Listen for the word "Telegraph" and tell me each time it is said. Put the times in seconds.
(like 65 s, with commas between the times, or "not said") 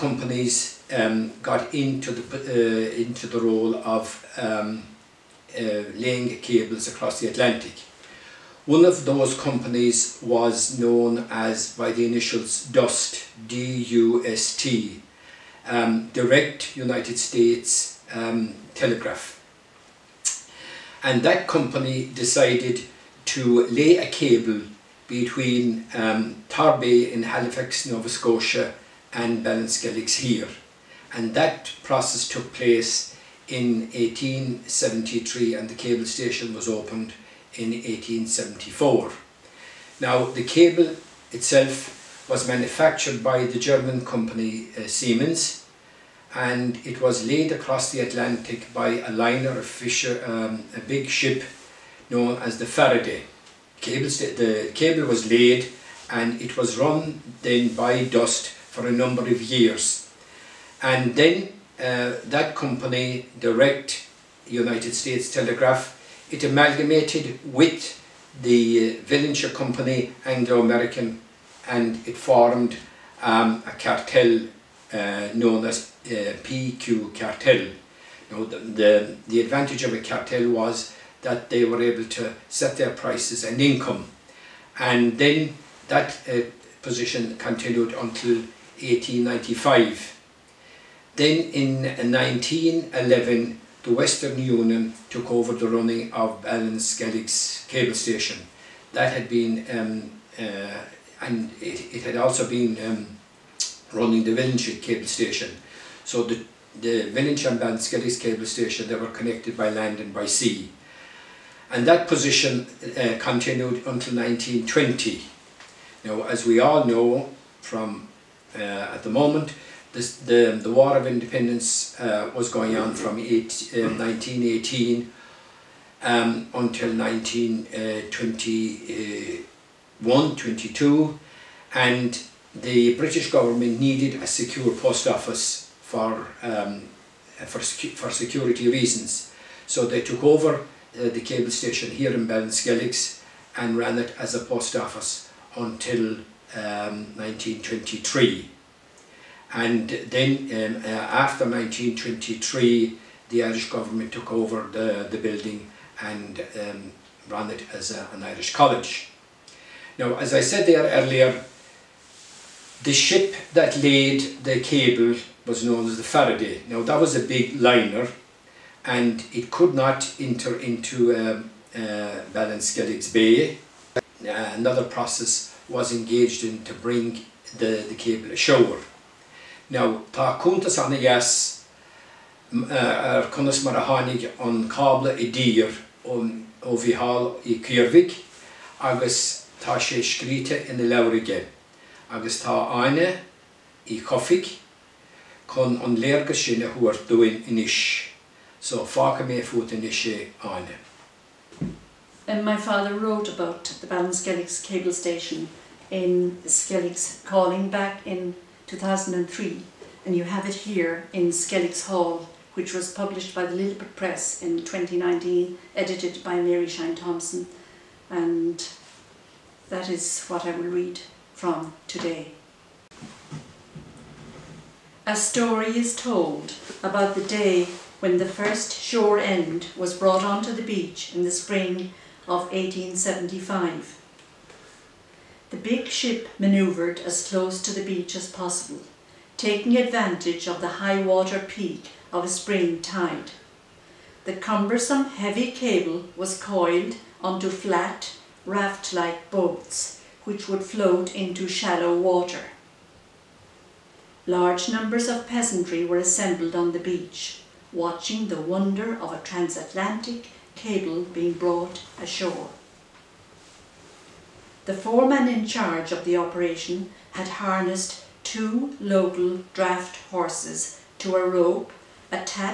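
18 s, 65 s.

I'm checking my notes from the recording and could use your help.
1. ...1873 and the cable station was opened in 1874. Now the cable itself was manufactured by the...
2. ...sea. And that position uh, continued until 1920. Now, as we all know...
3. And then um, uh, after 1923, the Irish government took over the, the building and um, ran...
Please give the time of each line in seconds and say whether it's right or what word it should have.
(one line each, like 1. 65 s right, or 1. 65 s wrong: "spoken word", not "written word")
1. 33 s right
2. 110 s right
3. 149 s right.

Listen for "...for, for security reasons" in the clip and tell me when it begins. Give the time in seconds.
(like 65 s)
137 s.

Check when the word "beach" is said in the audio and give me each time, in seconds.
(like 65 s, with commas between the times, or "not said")
230 s, 237 s, 256 s.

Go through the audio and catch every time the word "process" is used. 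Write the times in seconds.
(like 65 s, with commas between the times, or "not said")
31 s, 174 s.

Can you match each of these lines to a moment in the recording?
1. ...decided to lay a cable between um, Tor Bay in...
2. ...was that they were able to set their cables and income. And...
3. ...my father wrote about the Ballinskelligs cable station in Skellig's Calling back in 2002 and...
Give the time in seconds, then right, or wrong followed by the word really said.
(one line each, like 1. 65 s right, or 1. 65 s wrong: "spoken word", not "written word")
1. 22 s right
2. 80 s wrong: "prices", not "cables"
3. 202 s wrong: "2003", not "2002".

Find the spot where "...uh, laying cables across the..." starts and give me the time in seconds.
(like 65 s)
5 s.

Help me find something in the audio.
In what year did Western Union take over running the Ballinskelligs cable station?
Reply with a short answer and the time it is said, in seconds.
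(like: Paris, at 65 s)
1911, at 91 s.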